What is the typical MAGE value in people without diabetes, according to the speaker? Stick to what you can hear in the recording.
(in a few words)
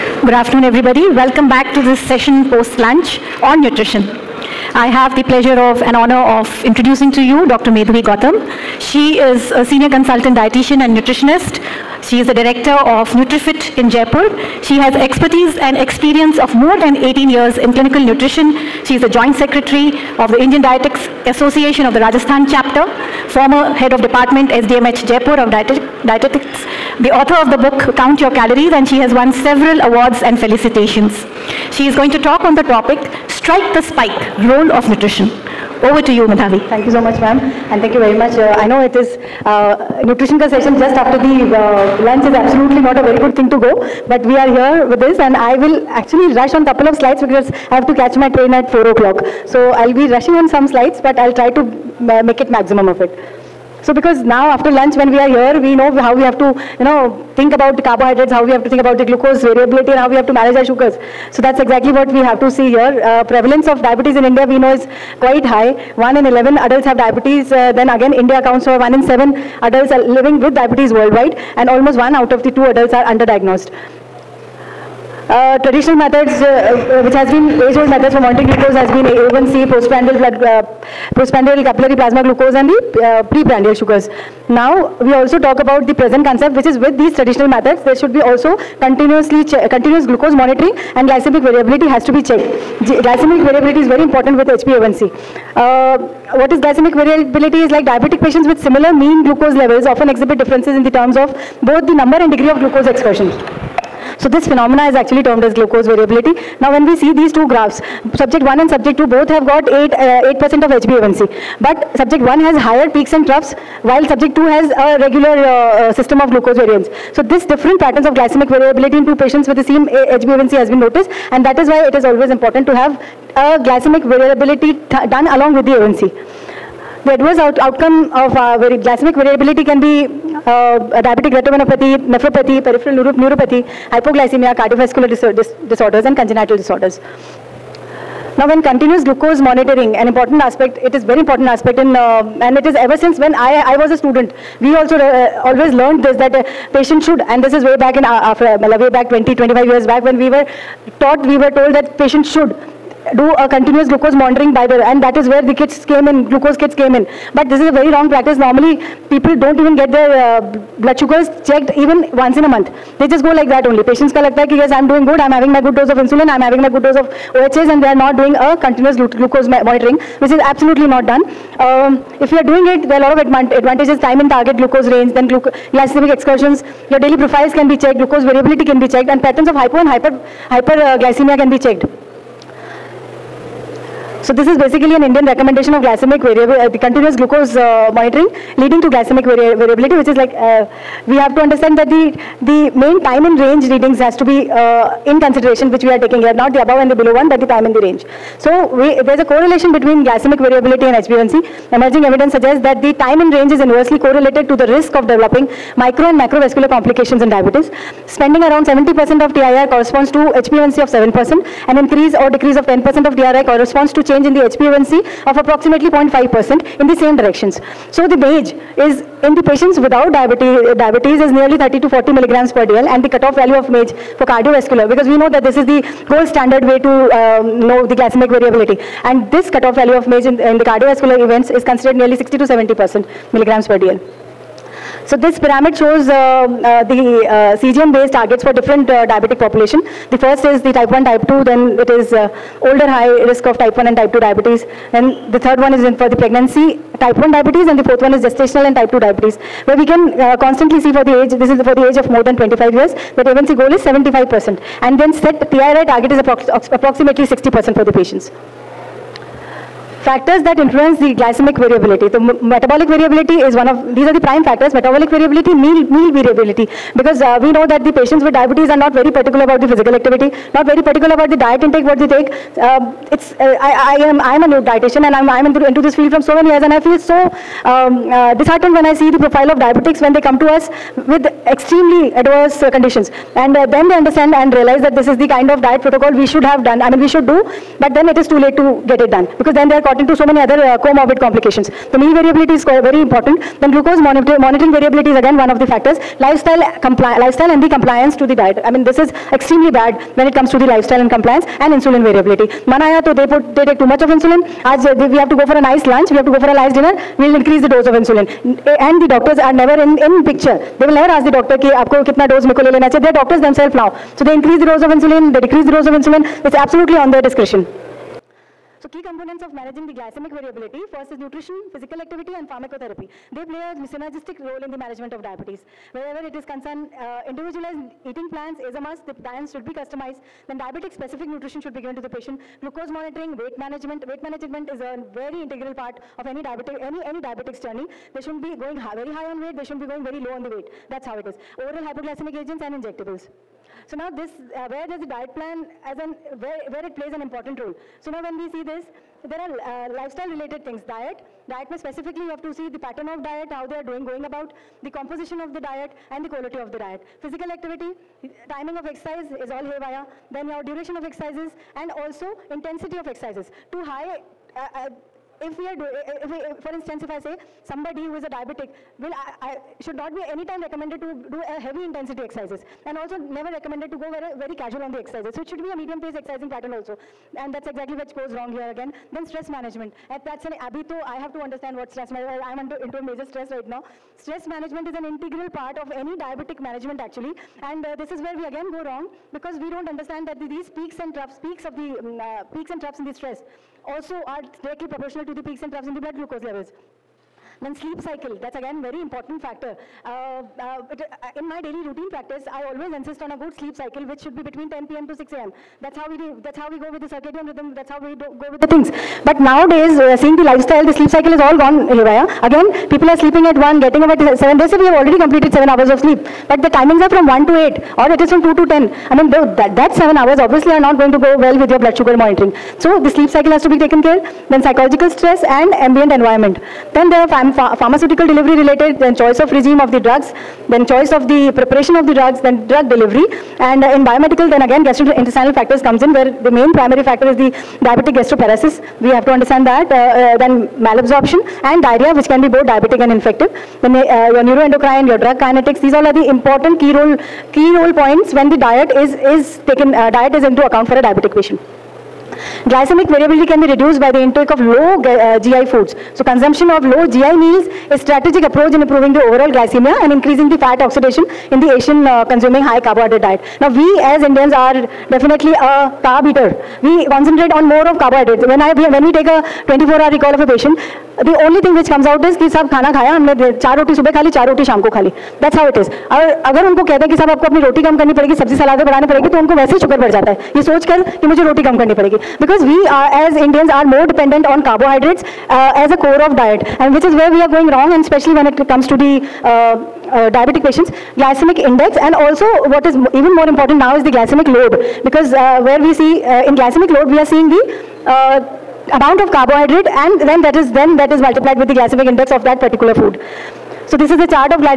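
30 to 40 mg/dl.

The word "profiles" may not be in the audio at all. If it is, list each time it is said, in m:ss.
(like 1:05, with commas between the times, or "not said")
2:57, 4:39.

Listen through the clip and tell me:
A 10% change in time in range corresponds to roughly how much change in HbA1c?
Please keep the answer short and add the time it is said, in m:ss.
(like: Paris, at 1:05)
0.5%, at 3:35.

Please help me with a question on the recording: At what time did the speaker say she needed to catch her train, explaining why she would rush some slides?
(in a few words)
4 o'clock.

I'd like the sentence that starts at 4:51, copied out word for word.
So meal variability is very important.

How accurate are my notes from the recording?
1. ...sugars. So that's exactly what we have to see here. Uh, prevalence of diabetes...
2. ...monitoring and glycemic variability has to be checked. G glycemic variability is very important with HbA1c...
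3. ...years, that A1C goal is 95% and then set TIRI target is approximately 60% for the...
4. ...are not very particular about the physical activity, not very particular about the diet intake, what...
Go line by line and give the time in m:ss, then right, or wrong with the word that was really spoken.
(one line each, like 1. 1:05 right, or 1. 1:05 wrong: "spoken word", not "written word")
1. 1:00 right
2. 1:30 right
3. 4:12 wrong: "75", not "95"
4. 4:28 right.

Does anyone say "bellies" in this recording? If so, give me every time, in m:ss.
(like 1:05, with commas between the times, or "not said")
not said.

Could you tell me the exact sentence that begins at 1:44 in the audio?
So this phenomena is actually termed as glucose variability.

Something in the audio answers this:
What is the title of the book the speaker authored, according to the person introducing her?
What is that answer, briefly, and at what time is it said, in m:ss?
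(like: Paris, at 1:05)
Count Your Calories, at 0:27.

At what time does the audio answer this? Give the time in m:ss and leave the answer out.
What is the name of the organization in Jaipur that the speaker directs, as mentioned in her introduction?
0:13.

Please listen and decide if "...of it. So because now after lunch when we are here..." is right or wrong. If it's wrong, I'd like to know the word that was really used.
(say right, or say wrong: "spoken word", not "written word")
right.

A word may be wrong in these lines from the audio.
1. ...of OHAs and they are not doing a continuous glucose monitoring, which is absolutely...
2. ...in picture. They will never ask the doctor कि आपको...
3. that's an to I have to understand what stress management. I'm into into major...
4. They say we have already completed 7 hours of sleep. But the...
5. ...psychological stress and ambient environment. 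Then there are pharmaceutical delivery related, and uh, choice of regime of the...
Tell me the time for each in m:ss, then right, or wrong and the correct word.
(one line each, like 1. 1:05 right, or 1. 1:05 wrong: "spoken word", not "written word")
1. 2:46 right
2. 5:09 right
3. 6:20 right
4. 6:54 right
5. 7:04 right.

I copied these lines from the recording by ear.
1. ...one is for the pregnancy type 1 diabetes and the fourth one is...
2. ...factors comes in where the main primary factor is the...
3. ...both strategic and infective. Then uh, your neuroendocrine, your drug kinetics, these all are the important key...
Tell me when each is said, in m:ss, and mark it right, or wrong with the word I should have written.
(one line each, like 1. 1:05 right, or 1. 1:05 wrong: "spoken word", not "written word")
1. 4:05 right
2. 7:15 right
3. 7:22 wrong: "diabetic", not "strategic".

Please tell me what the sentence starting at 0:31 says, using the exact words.
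She is going to talk on the topic Strike the Spike, Role of Nutrition.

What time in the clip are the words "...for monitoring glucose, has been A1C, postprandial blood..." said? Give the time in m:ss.
1:18.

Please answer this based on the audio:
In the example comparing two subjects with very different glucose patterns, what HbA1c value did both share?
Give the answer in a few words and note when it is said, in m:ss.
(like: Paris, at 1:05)
8%, at 1:49.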